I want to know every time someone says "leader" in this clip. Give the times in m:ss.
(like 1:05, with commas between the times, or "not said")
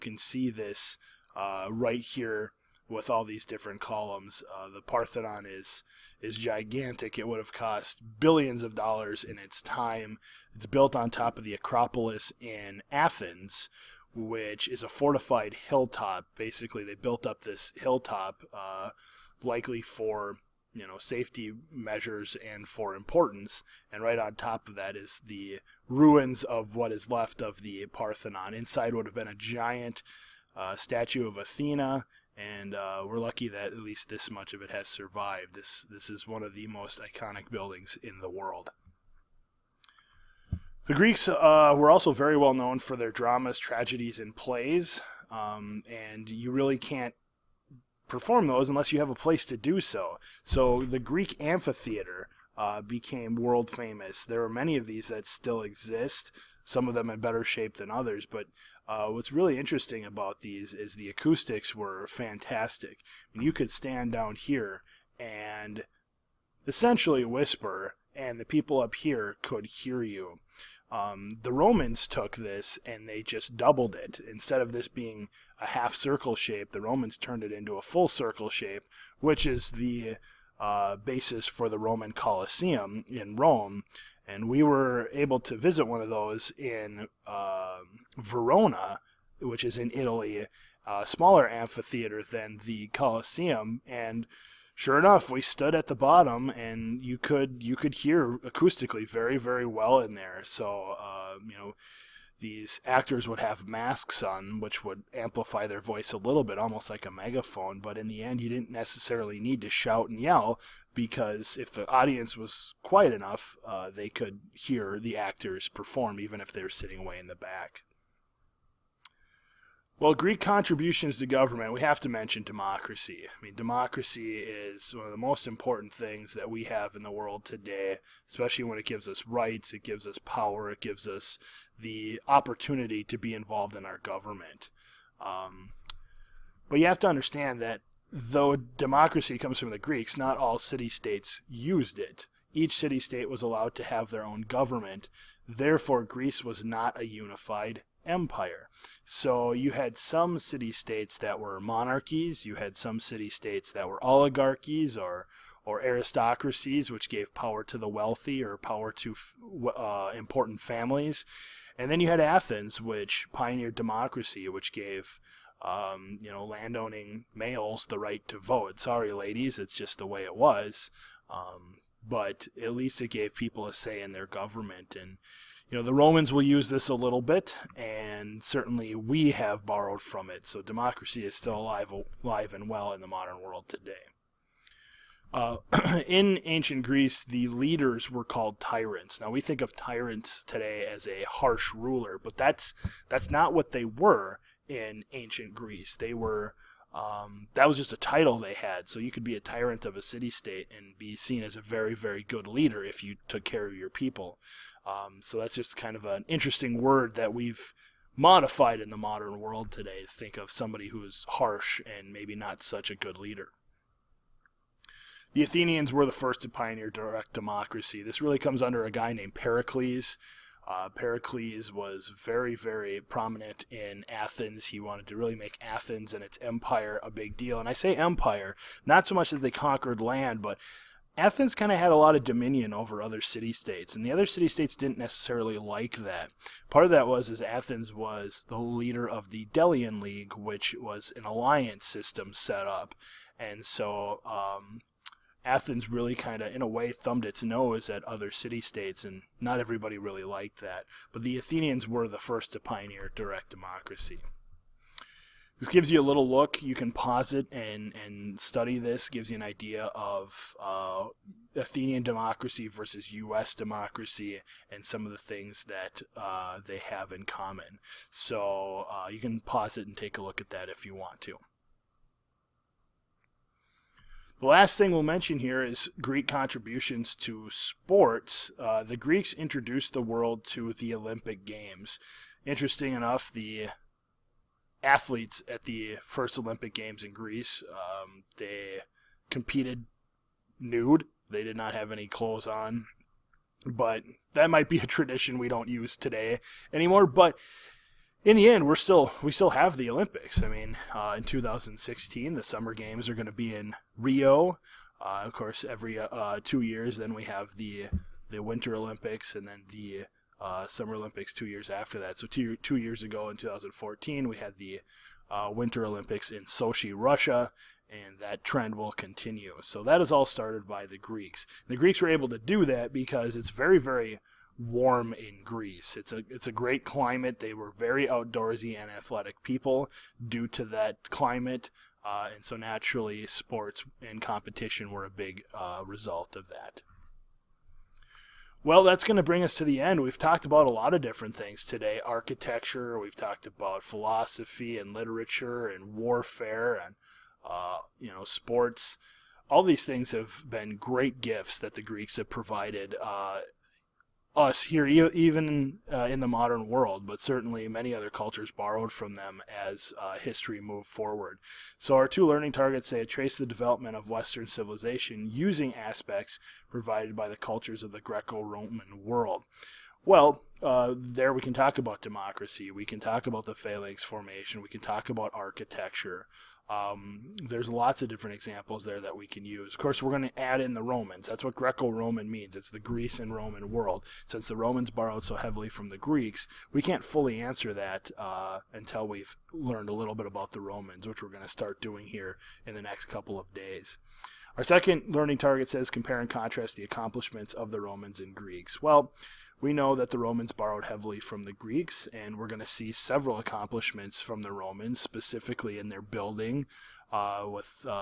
3:07, 3:22, 3:33, 3:58.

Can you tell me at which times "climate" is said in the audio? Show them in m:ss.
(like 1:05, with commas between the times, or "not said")
5:26, 5:31.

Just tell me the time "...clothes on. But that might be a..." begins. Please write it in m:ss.
4:52.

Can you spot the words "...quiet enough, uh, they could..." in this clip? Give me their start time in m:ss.
1:52.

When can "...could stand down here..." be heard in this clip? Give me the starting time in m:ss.
1:03.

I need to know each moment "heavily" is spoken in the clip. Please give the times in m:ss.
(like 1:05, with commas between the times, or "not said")
6:25, 6:40.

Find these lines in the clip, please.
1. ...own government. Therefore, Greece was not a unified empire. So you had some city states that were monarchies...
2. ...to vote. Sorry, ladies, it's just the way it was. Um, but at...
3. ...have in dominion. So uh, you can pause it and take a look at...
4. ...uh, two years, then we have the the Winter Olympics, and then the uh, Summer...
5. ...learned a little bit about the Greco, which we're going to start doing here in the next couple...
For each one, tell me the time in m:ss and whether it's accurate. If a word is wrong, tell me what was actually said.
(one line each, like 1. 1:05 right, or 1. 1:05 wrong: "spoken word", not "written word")
1. 2:24 right
2. 2:48 right
3. 4:26 wrong: "common", not "dominion"
4. 5:05 right
5. 6:29 wrong: "Romans", not "Greco".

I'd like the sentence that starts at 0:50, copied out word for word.
So the Greek amphitheater uh, became world famous.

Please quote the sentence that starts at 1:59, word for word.
Well, Greek contributions to government, we have to mention democracy.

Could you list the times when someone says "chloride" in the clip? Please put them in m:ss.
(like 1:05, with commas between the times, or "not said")
not said.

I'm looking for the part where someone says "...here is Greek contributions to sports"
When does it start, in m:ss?
4:35.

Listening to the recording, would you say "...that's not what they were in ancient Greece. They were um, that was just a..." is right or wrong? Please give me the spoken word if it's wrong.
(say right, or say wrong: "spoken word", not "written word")
right.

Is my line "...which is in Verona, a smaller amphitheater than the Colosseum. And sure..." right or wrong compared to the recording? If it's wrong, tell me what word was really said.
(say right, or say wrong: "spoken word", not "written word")
wrong: "Italy", not "Verona".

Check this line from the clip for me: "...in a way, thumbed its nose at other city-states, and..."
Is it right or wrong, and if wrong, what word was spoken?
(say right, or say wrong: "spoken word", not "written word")
right.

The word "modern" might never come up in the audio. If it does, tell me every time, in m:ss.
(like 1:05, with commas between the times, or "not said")
3:03, 3:28, 5:56.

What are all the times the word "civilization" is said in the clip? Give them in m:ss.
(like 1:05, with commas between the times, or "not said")
6:04.